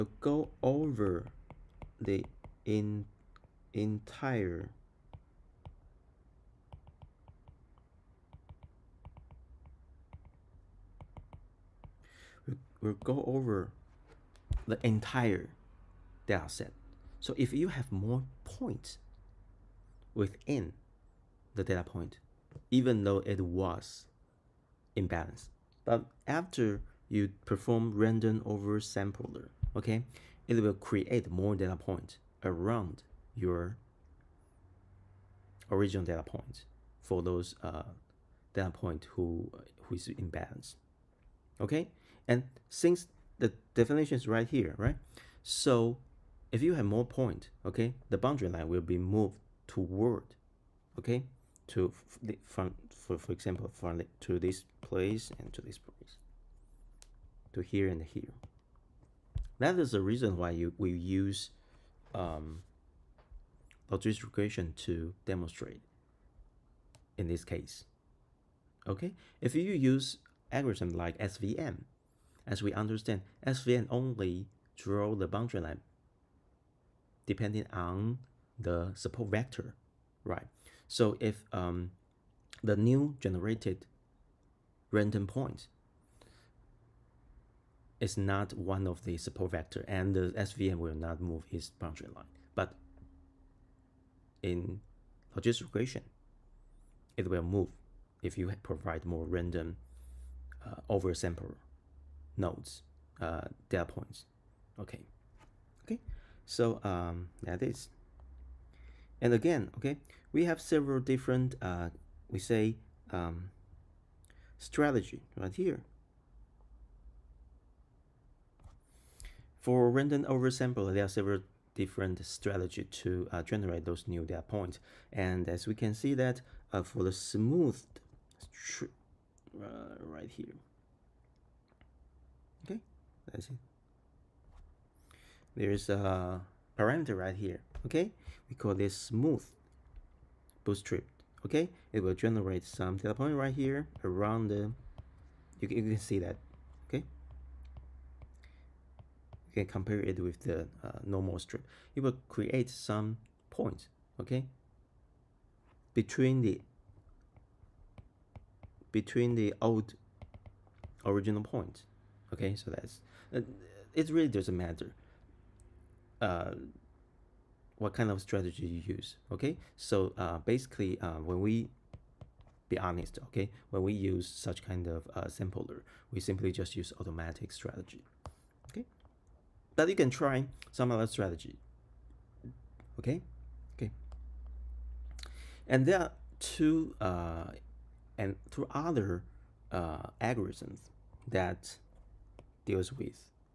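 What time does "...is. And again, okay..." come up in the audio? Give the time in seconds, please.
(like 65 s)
107 s.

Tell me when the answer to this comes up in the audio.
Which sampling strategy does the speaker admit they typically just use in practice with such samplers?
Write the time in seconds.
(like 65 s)
177 s.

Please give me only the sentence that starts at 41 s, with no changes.
Okay, and since the definition is right here, right?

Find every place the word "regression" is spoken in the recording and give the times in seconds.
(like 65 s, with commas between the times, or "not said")
64 s, 95 s.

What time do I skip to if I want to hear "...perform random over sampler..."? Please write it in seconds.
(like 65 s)
27 s.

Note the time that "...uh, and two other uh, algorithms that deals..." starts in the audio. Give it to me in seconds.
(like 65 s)
187 s.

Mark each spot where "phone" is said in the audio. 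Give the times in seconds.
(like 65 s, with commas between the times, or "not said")
not said.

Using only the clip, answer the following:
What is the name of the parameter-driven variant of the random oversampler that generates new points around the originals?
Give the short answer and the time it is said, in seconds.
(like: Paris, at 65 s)
Smooth bootstrap, at 138 s.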